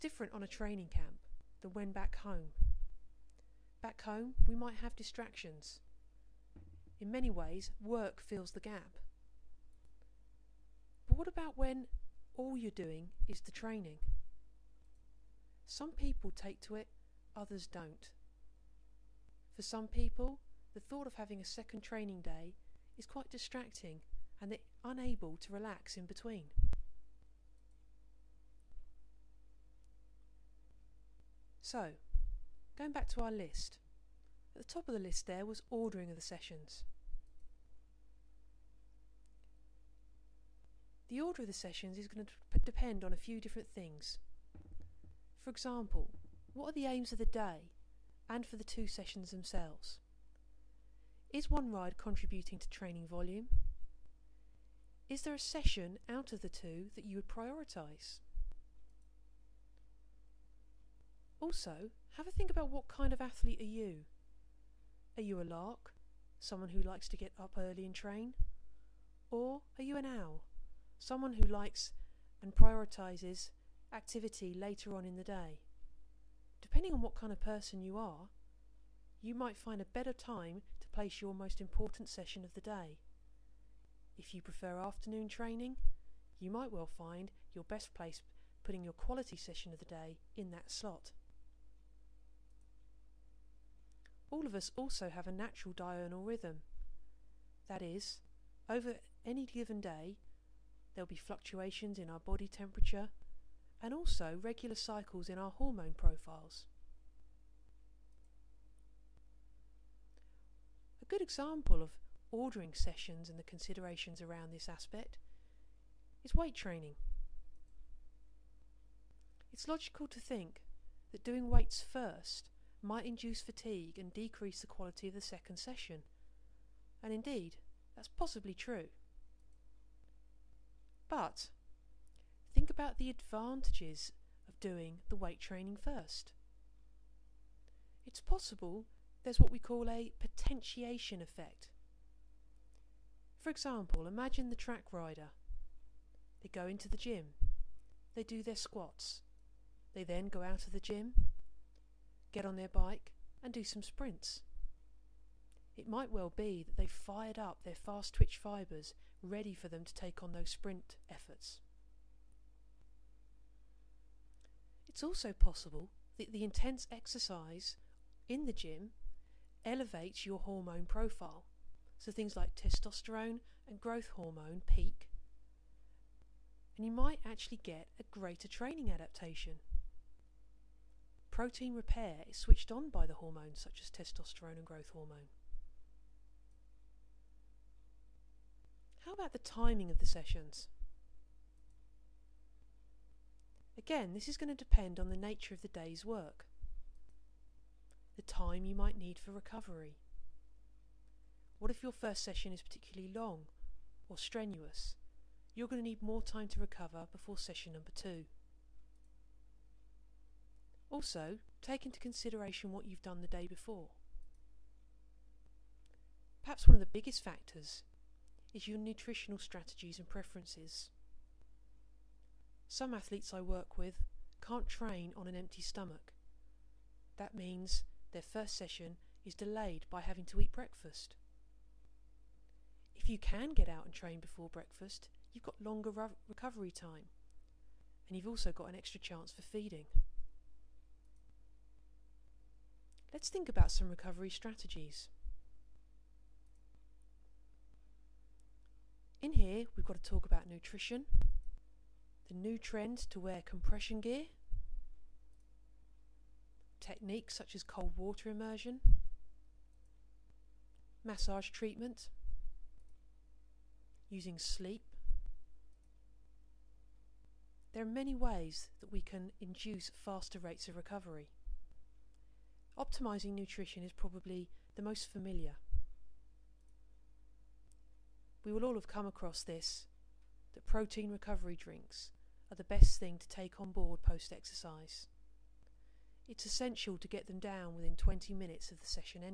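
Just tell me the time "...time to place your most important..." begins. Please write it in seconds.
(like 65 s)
80 s.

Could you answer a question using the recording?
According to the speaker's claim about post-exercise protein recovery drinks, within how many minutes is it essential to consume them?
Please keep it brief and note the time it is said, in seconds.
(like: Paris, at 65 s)
20 minutes, at 287 s.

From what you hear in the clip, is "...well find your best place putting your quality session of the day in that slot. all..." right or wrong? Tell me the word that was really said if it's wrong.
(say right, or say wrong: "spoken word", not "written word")
right.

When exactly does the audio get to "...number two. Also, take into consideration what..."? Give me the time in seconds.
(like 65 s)
207 s.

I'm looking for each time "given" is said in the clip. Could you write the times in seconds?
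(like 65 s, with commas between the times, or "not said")
99 s.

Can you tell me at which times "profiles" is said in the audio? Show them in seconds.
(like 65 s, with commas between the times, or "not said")
105 s, 170 s.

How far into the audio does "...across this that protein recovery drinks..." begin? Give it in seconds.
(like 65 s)
279 s.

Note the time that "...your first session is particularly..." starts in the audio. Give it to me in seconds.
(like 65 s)
201 s.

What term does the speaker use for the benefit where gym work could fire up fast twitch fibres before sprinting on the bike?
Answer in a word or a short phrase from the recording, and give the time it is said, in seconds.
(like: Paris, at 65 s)
Potentiation effect, at 140 s.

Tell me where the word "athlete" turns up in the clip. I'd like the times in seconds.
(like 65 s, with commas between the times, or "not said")
63 s, 222 s.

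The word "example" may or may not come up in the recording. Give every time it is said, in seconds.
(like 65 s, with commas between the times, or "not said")
45 s, 111 s, 143 s.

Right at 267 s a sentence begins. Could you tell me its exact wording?
There are many ways that we can induce faster rates of recovery.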